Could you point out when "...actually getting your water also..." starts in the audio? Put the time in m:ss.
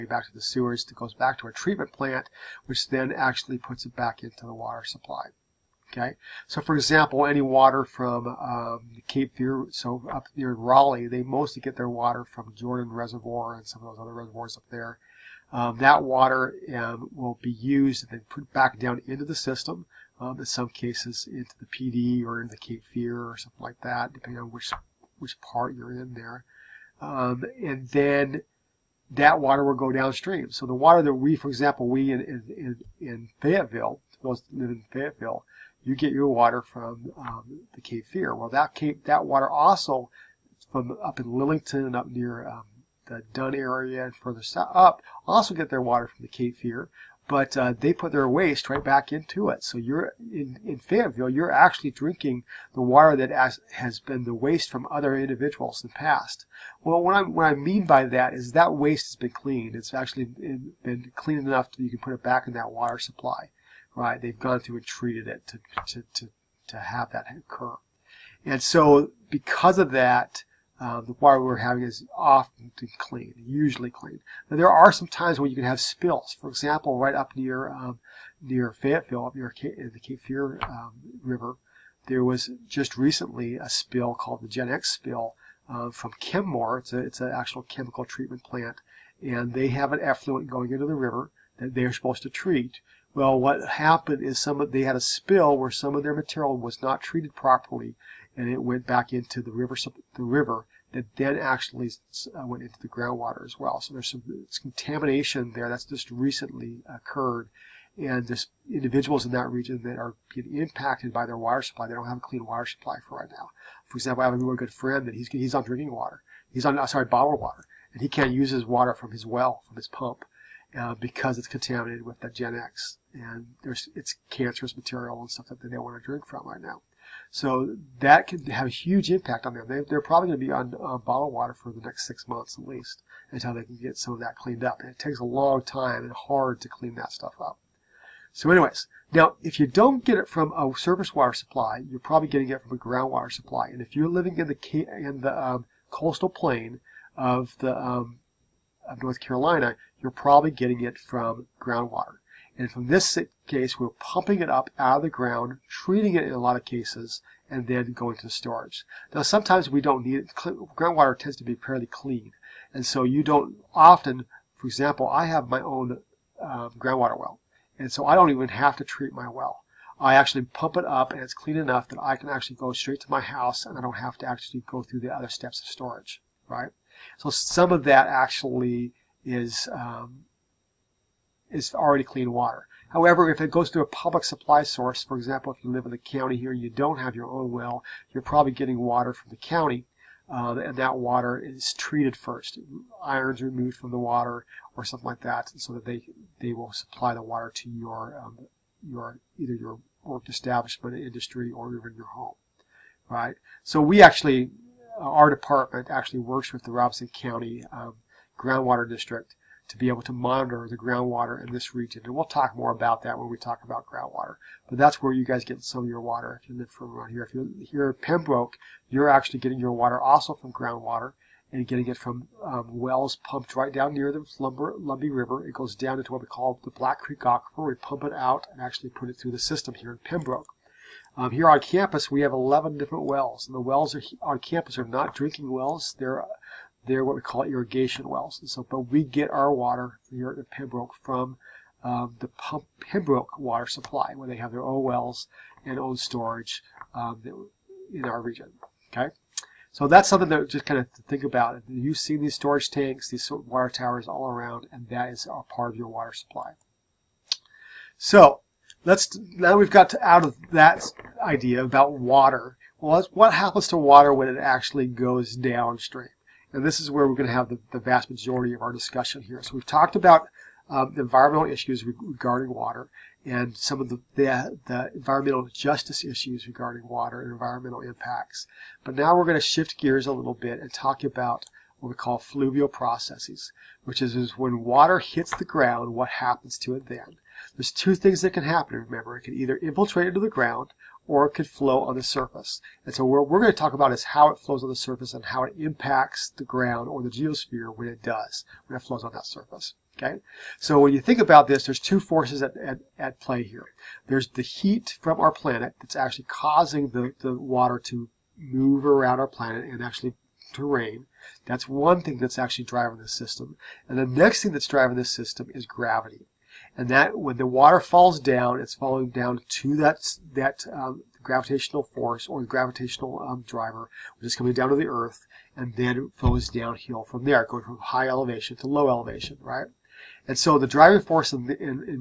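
3:39.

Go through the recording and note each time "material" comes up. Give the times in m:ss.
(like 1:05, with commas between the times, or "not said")
1:36, 2:04.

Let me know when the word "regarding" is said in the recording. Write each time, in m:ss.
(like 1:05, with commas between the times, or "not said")
4:31, 4:36.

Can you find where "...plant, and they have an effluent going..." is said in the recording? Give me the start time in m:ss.
1:28.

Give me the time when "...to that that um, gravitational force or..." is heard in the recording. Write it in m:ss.
5:19.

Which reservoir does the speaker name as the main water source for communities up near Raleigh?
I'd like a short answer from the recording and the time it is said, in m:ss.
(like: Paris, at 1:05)
Jordan Reservoir, at 0:12.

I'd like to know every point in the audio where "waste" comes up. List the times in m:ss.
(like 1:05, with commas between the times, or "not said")
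0:48, 0:54, 0:58.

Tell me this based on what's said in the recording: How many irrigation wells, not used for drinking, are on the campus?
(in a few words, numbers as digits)
11.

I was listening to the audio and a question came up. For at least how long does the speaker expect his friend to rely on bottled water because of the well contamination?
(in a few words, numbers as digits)
6 months.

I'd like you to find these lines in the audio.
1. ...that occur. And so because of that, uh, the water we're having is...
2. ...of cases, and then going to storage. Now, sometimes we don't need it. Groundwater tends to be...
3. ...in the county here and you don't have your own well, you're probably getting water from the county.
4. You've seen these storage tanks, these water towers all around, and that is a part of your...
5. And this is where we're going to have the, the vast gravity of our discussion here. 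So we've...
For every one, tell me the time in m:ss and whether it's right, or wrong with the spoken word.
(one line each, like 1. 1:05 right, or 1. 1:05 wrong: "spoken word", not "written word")
1. 1:07 right
2. 2:36 right
3. 3:05 right
4. 4:11 right
5. 4:26 wrong: "majority", not "gravity".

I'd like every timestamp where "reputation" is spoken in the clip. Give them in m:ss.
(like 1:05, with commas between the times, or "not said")
not said.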